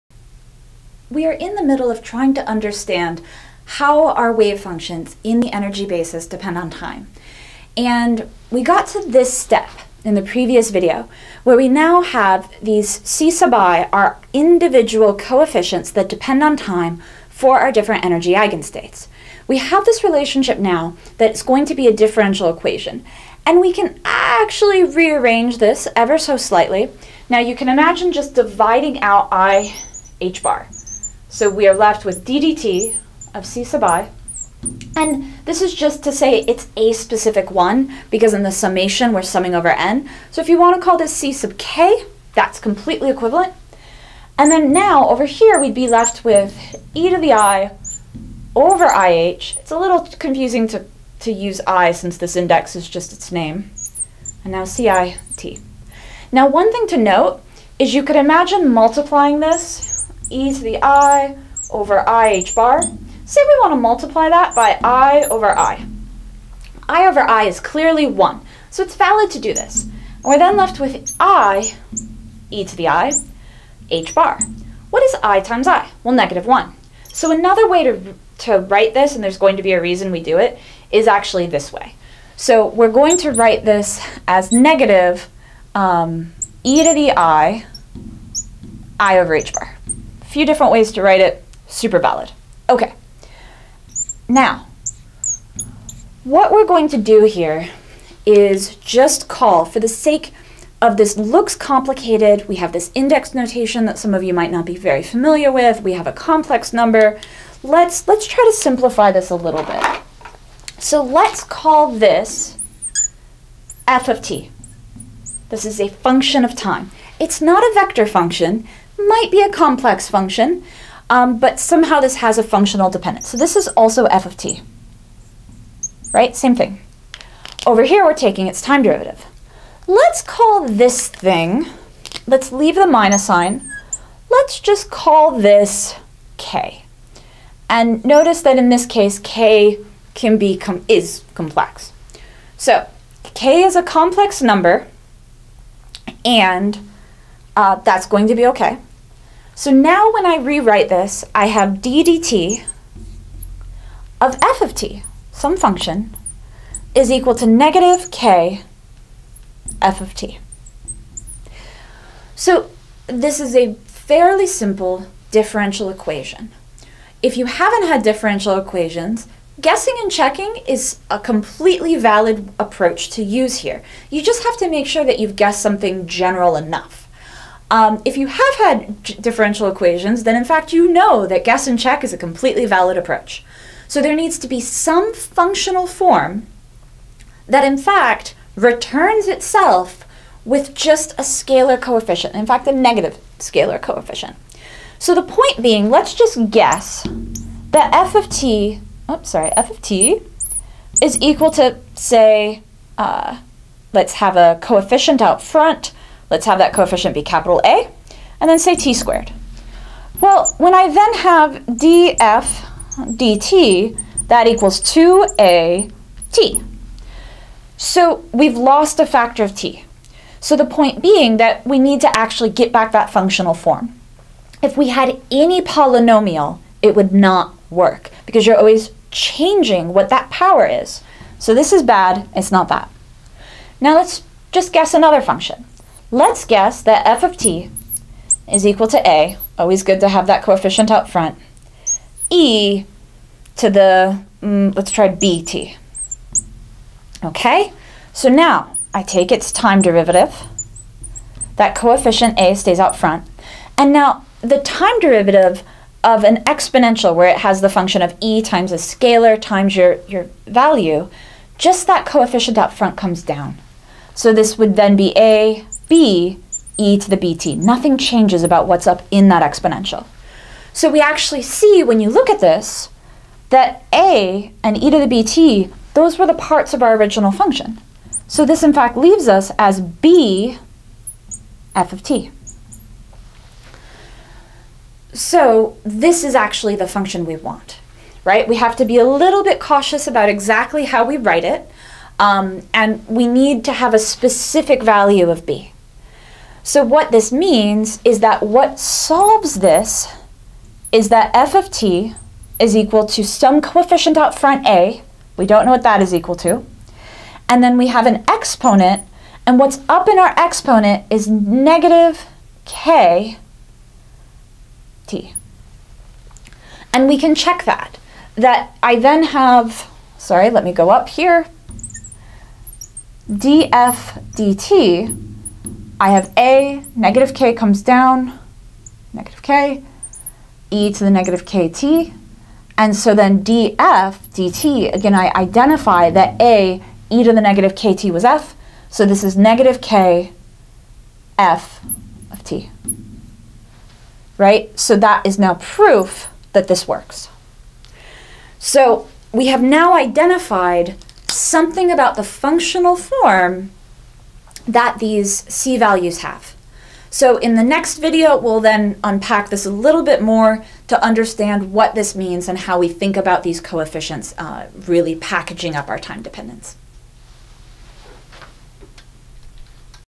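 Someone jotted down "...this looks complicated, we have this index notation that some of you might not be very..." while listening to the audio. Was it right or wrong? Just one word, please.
right.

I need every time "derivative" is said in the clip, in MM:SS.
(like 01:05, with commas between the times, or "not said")
02:08, 04:09, 04:14.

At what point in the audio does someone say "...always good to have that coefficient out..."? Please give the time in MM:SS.
03:59.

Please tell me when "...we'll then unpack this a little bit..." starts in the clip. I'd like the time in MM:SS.
05:58.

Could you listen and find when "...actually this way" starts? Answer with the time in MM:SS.
01:21.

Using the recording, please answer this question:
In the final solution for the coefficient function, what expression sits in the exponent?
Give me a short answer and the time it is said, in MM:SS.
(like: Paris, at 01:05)
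negative k t, at 05:11.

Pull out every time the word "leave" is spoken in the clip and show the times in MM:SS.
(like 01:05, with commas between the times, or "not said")
02:12, 04:38.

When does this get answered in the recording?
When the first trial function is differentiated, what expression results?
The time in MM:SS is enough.
03:34.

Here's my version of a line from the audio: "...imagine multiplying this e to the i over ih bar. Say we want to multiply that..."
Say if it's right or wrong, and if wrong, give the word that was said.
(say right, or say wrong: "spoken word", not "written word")
right.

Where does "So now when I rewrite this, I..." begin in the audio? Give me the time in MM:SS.
02:29.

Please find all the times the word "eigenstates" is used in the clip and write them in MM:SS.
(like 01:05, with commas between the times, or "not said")
00:18.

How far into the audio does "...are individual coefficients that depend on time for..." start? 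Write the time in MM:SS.
00:13.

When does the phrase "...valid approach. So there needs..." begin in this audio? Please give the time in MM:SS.
03:02.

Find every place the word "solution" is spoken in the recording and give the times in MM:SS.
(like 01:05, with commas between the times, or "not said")
not said.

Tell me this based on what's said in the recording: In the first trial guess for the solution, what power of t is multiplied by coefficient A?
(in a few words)
t squared.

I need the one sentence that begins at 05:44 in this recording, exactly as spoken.
So that is now proof that this works.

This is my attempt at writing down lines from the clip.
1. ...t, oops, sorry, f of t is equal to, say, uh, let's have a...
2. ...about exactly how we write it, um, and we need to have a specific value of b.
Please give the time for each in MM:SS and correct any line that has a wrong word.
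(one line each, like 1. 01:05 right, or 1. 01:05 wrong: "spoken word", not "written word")
1. 03:18 right
2. 04:50 right.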